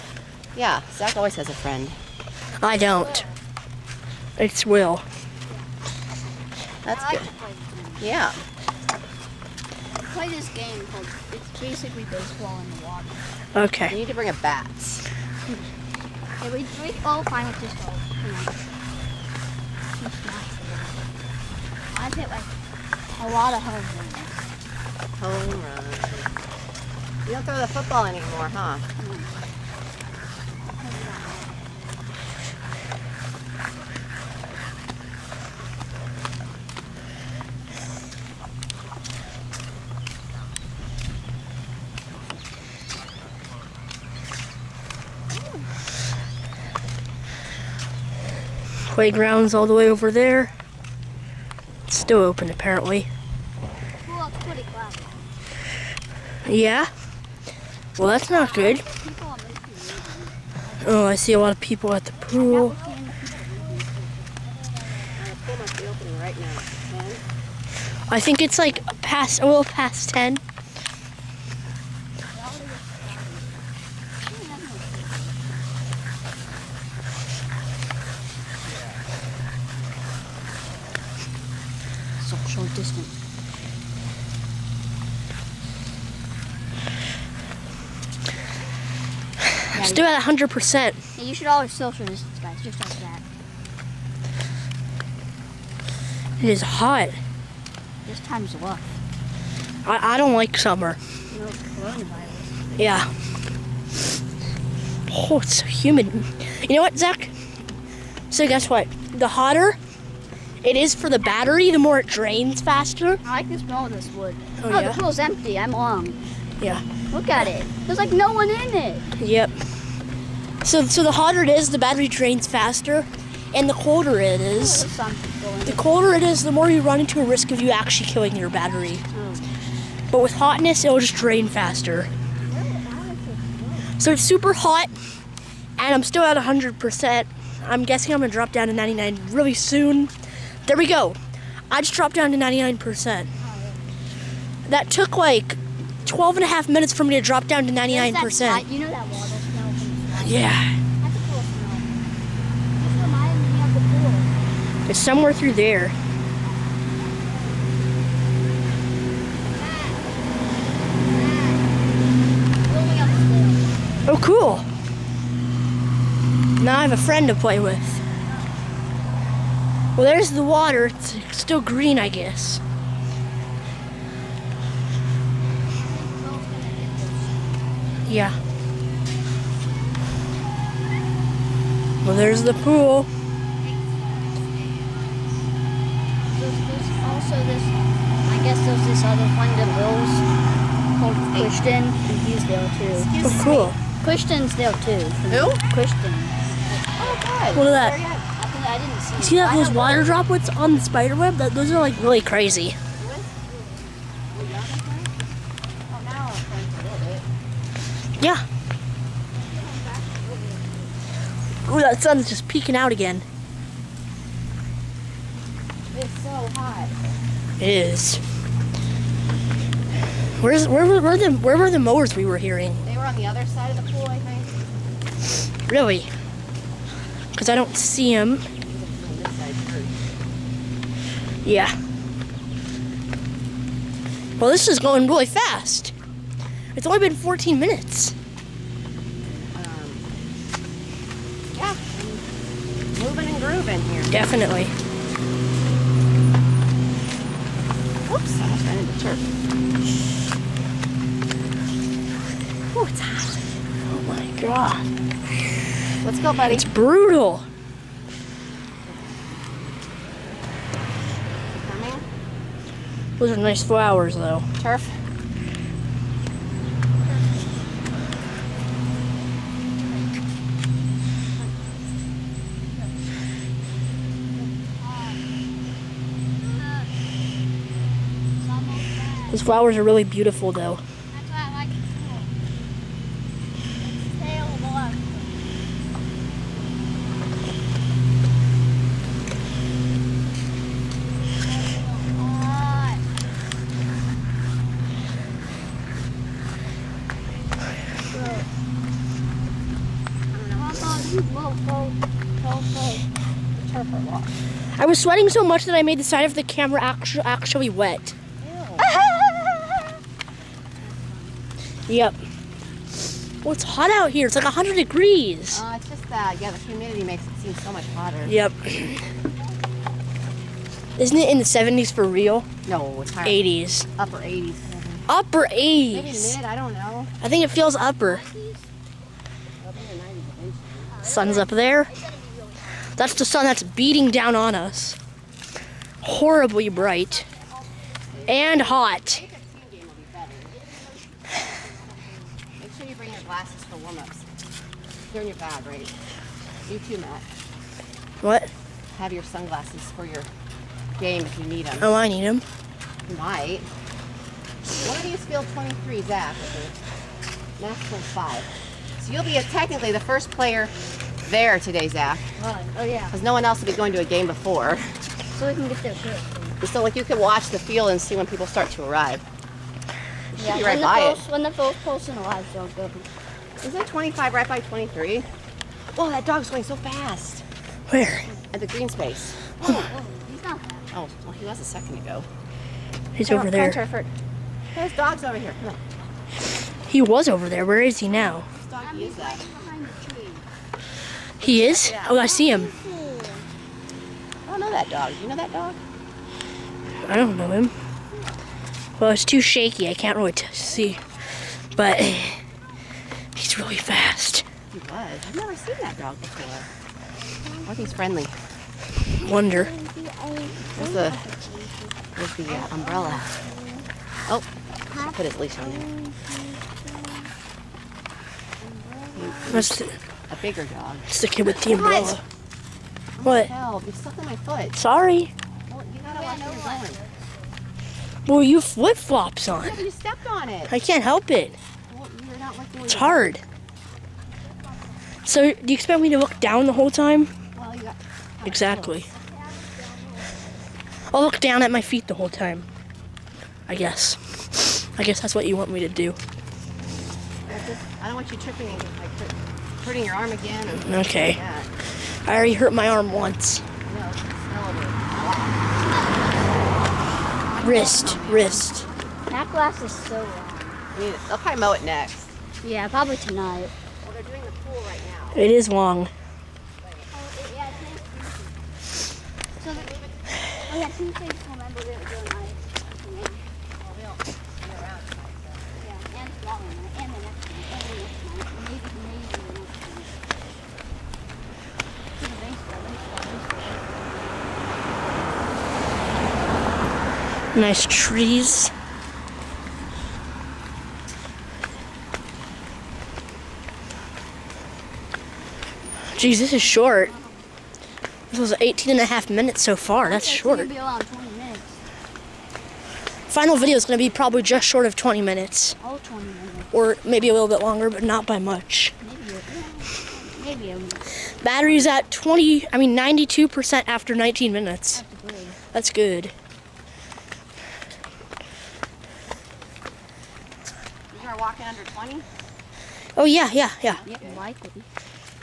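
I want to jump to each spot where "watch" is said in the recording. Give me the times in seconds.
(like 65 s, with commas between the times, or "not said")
367 s, 426 s.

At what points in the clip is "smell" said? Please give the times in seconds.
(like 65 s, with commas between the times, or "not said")
113 s.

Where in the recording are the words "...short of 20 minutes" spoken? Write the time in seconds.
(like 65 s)
504 s.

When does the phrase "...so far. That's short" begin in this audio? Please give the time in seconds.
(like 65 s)
499 s.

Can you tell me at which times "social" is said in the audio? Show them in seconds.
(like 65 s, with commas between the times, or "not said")
91 s.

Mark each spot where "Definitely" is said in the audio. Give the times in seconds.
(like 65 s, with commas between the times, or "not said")
244 s.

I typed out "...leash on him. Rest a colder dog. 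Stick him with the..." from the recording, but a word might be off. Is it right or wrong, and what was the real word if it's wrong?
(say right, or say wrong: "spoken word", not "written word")
wrong: "bigger", not "colder".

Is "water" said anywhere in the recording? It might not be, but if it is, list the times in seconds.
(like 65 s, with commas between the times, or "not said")
12 s, 149 s, 170 s, 199 s.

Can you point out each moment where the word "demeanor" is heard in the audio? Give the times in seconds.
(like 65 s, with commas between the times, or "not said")
not said.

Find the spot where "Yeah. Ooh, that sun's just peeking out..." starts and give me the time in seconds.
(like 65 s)
208 s.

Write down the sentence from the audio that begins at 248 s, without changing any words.
Oops, I almost ran into turf.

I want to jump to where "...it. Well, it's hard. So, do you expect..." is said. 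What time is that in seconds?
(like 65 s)
431 s.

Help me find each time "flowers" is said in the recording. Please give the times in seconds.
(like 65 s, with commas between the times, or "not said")
263 s, 279 s.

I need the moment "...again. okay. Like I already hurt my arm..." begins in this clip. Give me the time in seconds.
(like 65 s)
450 s.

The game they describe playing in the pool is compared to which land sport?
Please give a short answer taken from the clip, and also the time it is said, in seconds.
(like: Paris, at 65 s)
baseball, at 12 s.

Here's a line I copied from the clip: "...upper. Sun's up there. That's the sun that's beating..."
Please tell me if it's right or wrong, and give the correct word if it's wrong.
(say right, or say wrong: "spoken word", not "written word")
right.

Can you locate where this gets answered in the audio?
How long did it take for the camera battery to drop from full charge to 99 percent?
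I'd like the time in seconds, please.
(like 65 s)
146 s.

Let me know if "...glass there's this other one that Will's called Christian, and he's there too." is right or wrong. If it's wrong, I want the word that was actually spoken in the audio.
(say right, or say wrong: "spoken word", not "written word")
wrong: "guess", not "glass".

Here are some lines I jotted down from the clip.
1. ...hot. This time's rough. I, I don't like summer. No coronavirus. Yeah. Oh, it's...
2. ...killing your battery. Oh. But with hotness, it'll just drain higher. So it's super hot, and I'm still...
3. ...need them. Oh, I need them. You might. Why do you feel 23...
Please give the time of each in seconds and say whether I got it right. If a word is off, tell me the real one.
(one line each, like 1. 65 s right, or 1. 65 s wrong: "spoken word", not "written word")
1. 96 s right
2. 128 s wrong: "faster", not "higher"
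3. 351 s right.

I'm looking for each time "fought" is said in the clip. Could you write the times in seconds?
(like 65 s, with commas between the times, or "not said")
not said.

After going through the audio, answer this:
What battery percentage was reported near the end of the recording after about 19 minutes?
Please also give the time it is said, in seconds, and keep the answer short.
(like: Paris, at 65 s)
92%, at 512 s.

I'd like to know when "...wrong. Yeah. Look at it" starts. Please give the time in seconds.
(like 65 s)
115 s.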